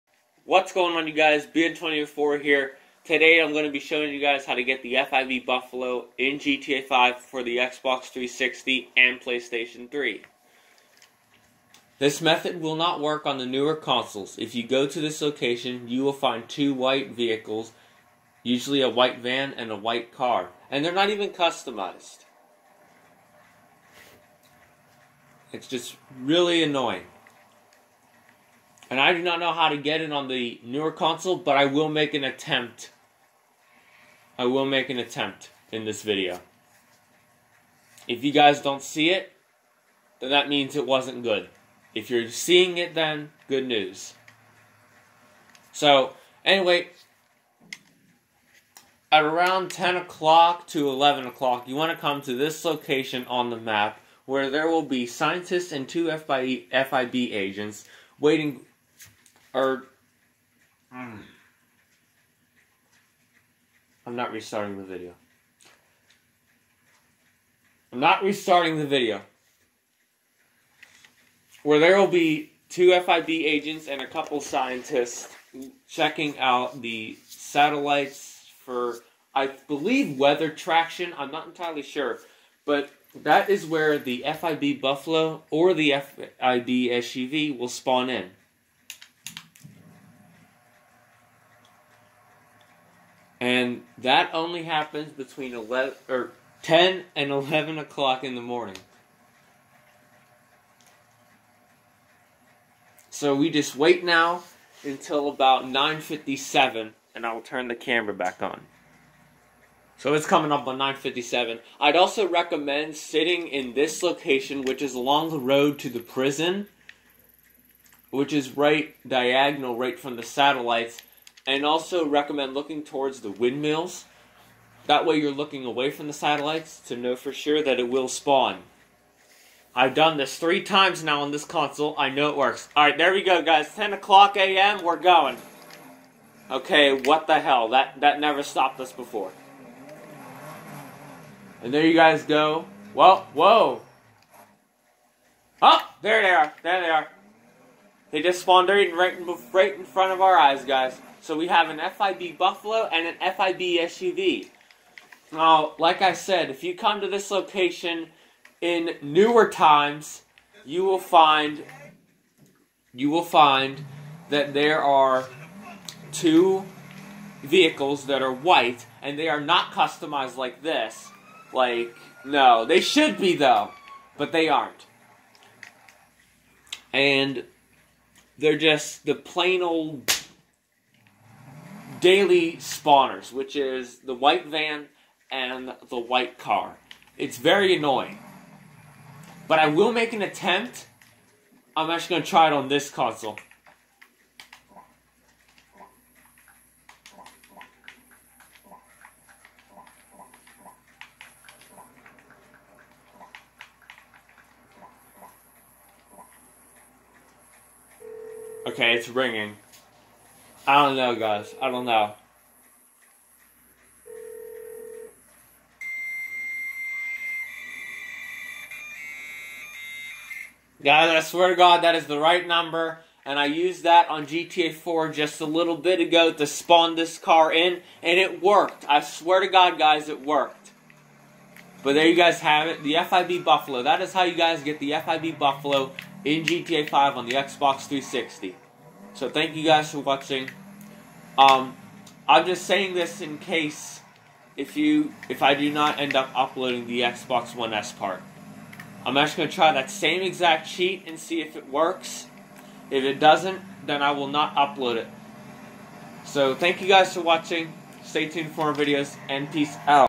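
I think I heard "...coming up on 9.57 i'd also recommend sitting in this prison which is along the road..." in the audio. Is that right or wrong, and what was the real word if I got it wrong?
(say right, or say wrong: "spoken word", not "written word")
wrong: "location", not "prison".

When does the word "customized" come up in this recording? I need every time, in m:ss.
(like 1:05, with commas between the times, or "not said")
0:21, 2:49.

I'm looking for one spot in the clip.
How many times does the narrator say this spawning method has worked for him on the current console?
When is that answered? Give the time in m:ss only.
2:10.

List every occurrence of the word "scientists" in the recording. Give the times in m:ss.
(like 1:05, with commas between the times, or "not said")
0:55, 1:14.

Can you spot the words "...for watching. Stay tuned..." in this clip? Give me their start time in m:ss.
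4:17.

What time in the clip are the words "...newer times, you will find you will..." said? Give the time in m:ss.
2:39.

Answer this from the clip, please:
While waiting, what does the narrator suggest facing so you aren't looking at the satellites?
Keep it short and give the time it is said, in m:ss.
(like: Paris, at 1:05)
the windmills, at 2:03.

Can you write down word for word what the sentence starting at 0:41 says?
If you're seeing it then, good news.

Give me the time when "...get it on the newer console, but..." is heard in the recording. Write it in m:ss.
0:29.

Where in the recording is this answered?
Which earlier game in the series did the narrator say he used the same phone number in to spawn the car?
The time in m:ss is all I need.
3:44.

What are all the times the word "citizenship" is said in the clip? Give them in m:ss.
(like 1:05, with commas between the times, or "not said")
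not said.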